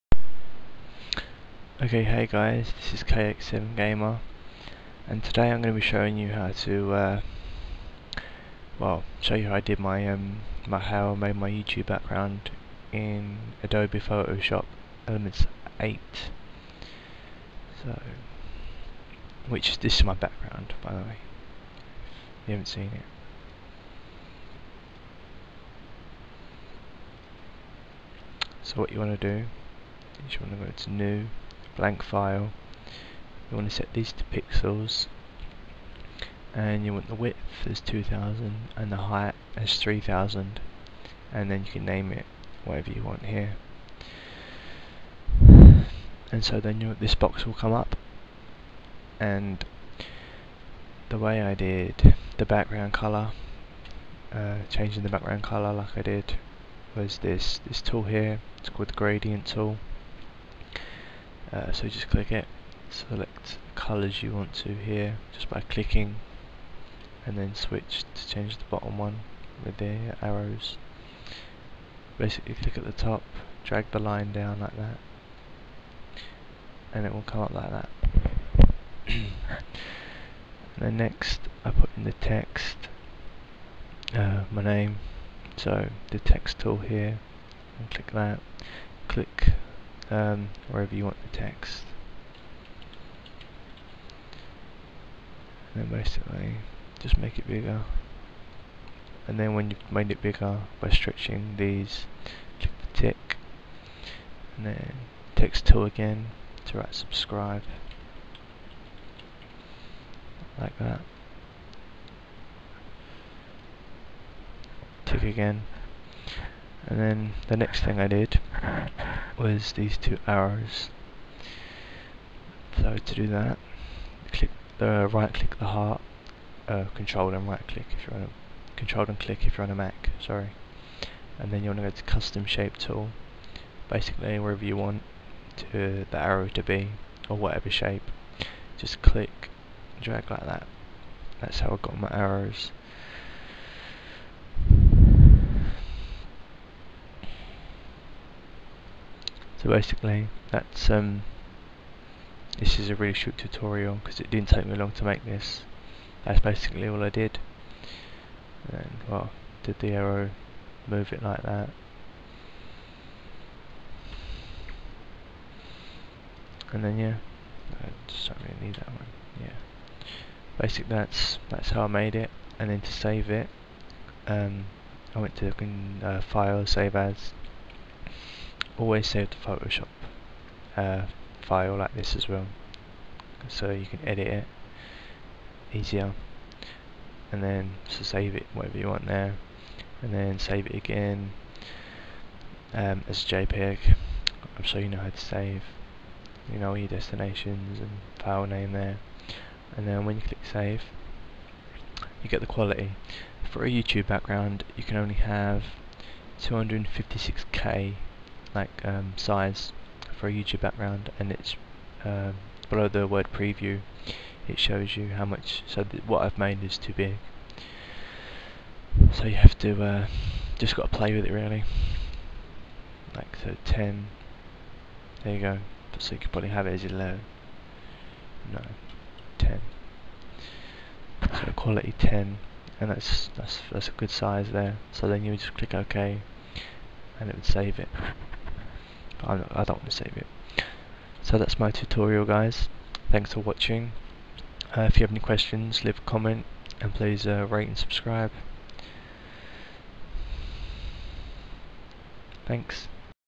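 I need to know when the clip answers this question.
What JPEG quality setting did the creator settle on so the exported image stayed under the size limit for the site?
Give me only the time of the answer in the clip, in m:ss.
3:51.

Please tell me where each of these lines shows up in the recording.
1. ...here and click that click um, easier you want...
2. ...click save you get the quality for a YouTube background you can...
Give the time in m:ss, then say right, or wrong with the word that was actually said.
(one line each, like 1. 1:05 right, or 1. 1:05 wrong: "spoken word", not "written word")
1. 1:26 wrong: "wherever", not "easier"
2. 3:20 right.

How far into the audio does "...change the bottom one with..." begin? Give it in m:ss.
1:08.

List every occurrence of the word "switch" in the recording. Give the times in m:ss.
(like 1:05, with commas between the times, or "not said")
1:07.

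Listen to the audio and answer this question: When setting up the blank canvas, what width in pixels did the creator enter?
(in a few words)
2000.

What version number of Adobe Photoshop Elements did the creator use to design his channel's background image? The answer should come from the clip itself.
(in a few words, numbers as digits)
8.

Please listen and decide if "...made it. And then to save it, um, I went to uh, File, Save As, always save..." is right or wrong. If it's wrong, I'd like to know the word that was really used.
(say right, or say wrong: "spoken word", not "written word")
right.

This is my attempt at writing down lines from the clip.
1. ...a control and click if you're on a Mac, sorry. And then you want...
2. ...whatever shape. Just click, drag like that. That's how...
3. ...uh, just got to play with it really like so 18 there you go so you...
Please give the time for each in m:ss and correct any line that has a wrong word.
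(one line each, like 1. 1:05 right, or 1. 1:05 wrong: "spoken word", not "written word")
1. 2:08 right
2. 2:17 right
3. 3:39 wrong: "10", not "18".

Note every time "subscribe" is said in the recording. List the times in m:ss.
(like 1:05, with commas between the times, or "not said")
1:46, 4:07.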